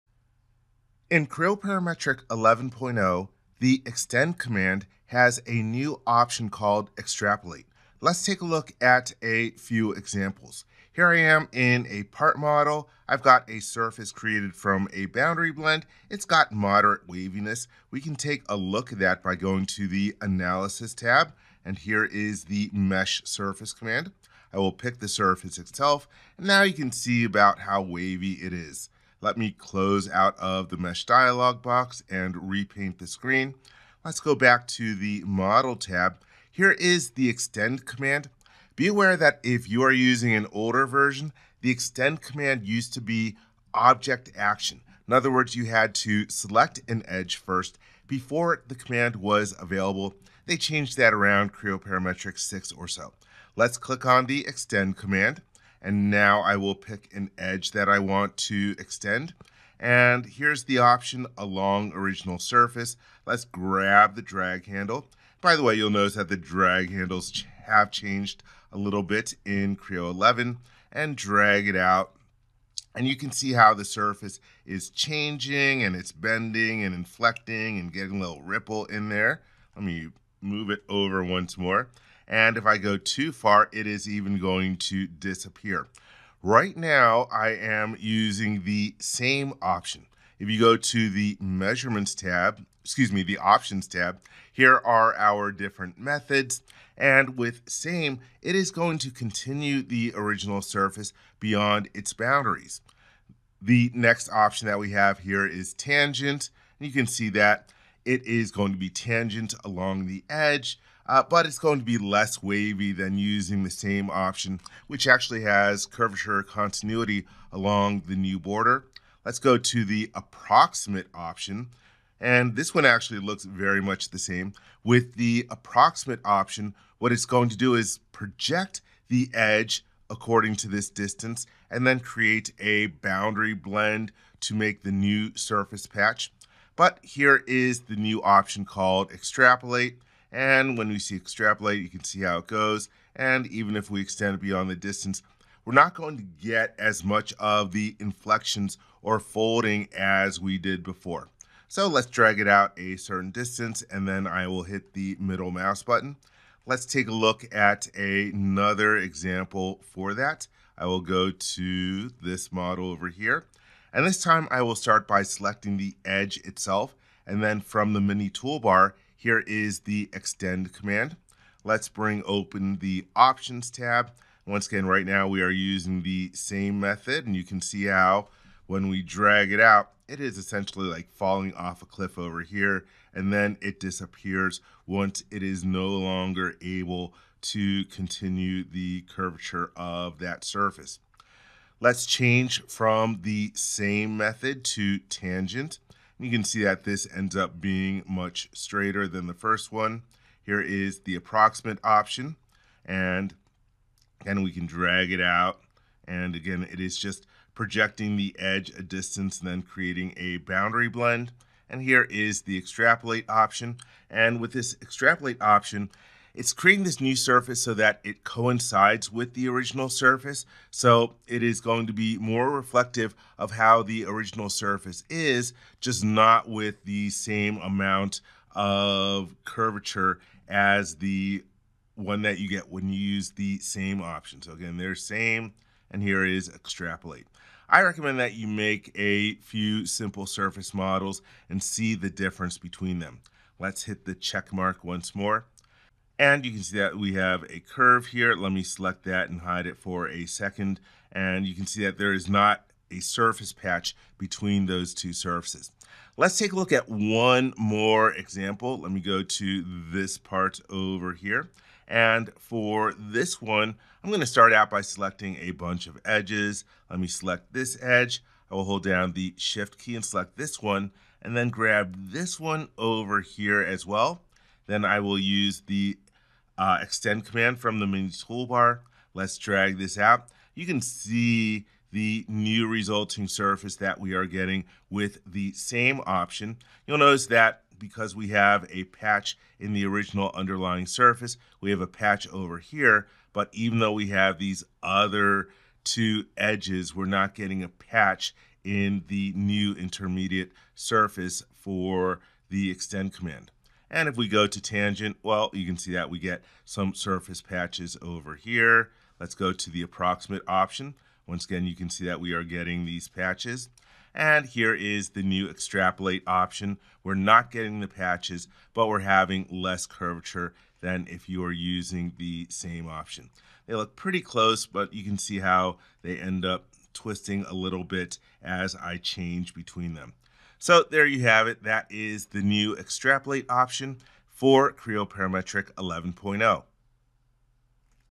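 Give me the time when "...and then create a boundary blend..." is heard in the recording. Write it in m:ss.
2:11.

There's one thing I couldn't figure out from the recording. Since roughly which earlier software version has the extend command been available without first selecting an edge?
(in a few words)
Creo Parametric 6.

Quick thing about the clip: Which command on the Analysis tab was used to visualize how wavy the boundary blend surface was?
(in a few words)
Mesh Surface.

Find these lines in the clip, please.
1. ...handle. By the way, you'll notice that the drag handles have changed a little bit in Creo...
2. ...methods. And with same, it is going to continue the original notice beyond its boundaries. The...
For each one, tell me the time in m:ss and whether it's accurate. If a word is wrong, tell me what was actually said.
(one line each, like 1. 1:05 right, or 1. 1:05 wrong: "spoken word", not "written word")
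1. 1:04 right
2. 1:35 wrong: "surface", not "notice".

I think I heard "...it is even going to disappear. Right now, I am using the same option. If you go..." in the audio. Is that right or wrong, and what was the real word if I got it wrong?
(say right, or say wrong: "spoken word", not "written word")
right.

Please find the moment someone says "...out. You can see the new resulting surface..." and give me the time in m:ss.
4:39.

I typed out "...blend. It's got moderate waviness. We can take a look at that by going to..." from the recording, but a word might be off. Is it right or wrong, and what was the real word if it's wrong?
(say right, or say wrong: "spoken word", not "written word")
right.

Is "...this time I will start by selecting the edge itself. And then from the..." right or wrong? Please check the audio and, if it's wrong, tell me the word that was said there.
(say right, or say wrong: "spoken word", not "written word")
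right.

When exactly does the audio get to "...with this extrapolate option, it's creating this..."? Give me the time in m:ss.
3:34.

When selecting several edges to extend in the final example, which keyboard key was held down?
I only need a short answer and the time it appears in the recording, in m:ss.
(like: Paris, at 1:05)
shift, at 4:29.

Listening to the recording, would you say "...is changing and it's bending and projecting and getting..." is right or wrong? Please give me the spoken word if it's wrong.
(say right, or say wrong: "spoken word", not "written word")
wrong: "inflecting", not "projecting".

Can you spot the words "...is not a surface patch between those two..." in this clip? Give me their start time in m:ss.
4:12.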